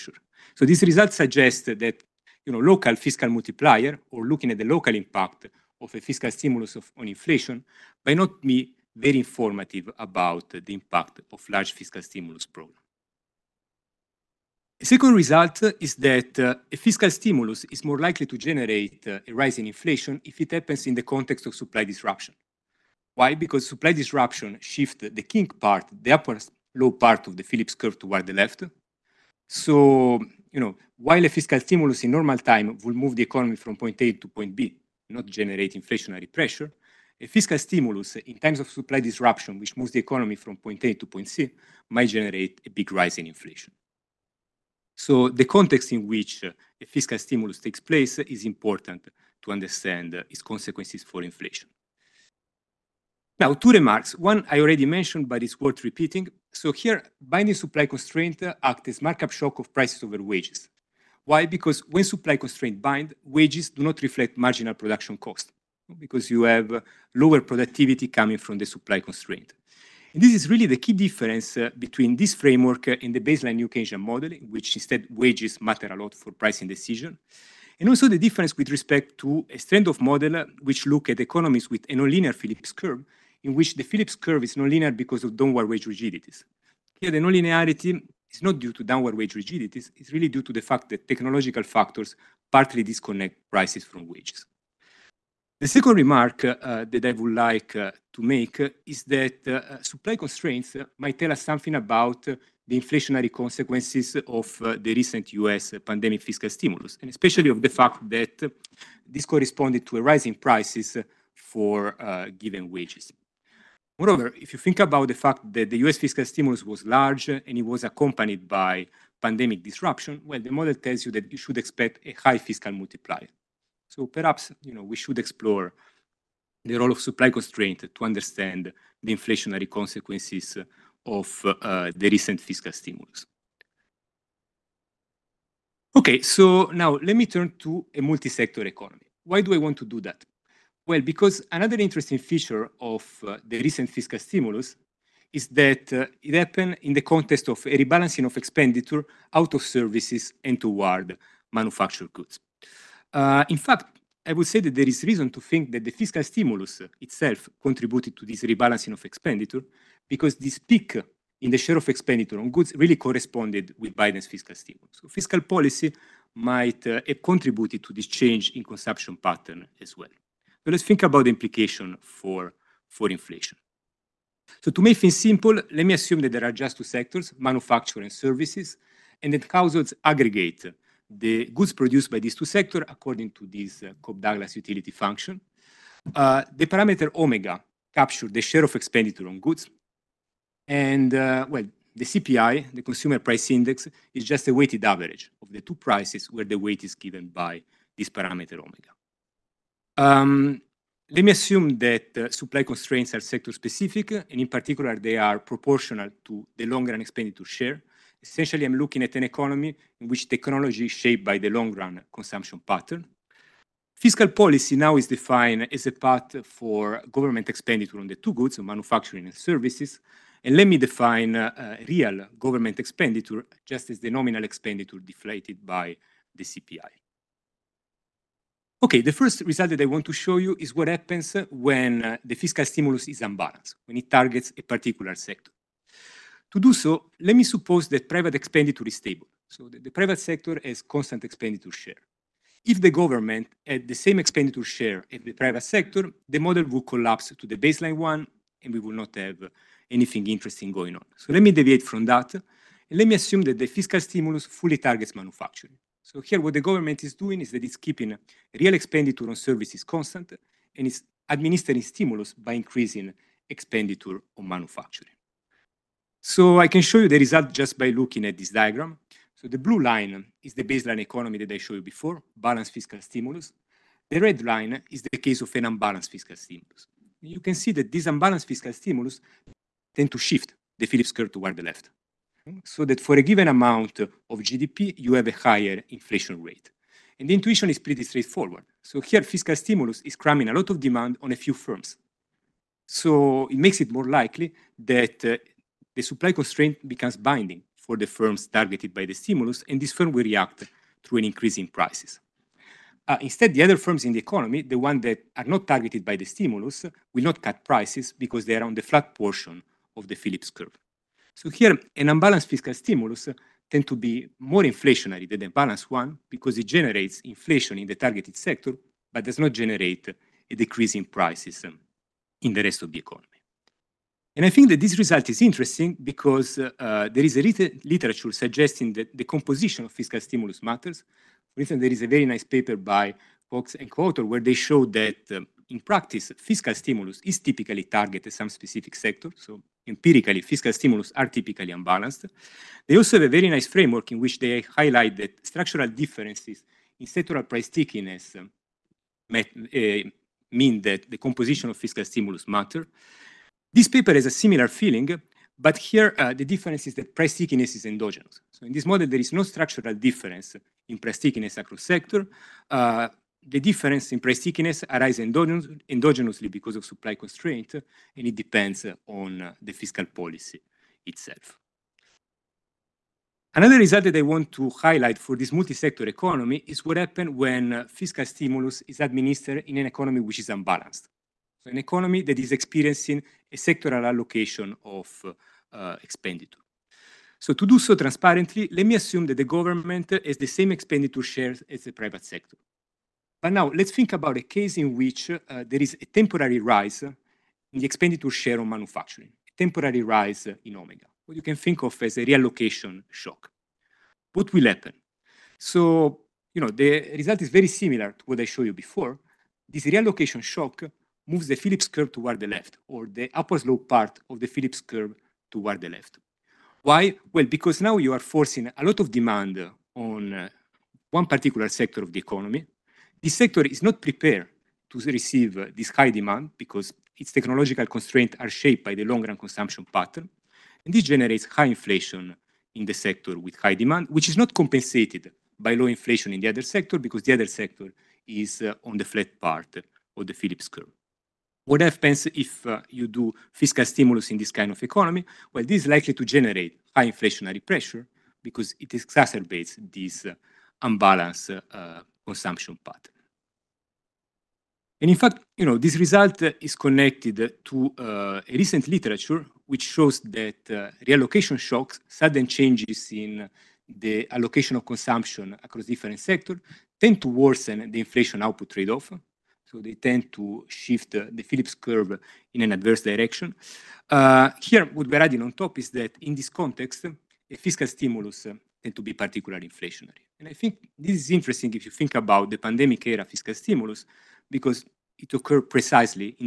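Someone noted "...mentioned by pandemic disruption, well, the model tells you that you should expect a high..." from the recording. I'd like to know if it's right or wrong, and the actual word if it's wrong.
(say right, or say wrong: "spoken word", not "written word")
wrong: "accompanied", not "mentioned".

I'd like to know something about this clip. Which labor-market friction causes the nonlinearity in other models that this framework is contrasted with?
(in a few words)
downward wage rigidities.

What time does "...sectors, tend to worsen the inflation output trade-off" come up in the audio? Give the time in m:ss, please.
7:46.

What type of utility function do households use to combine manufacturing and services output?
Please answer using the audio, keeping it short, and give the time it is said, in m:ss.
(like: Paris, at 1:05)
Cobb Douglas, at 3:04.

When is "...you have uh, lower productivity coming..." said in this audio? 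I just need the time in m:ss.
1:06.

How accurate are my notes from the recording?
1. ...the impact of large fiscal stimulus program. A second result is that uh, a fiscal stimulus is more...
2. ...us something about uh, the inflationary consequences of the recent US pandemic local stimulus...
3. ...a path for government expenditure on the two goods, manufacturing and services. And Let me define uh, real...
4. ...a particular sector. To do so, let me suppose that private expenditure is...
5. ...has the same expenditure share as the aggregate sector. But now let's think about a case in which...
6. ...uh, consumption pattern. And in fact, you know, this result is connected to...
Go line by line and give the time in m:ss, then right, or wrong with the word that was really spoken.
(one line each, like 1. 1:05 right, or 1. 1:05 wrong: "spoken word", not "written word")
1. 0:10 right
2. 1:41 wrong: "fiscal", not "local"
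3. 3:35 right
4. 3:54 right
5. 6:30 wrong: "private", not "aggregate"
6. 7:31 right.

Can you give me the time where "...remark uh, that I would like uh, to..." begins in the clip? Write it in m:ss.
1:35.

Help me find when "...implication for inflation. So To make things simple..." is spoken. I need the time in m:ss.
2:51.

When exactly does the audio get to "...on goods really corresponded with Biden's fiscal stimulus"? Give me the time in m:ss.
2:42.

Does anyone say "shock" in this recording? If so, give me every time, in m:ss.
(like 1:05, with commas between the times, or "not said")
0:59, 6:43, 6:50, 7:41.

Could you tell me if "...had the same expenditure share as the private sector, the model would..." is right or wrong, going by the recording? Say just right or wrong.
right.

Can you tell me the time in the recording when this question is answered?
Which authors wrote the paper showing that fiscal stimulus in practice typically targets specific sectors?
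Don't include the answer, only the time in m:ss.
5:33.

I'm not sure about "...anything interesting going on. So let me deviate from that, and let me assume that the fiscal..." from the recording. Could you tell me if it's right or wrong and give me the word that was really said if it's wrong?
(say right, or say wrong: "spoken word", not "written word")
right.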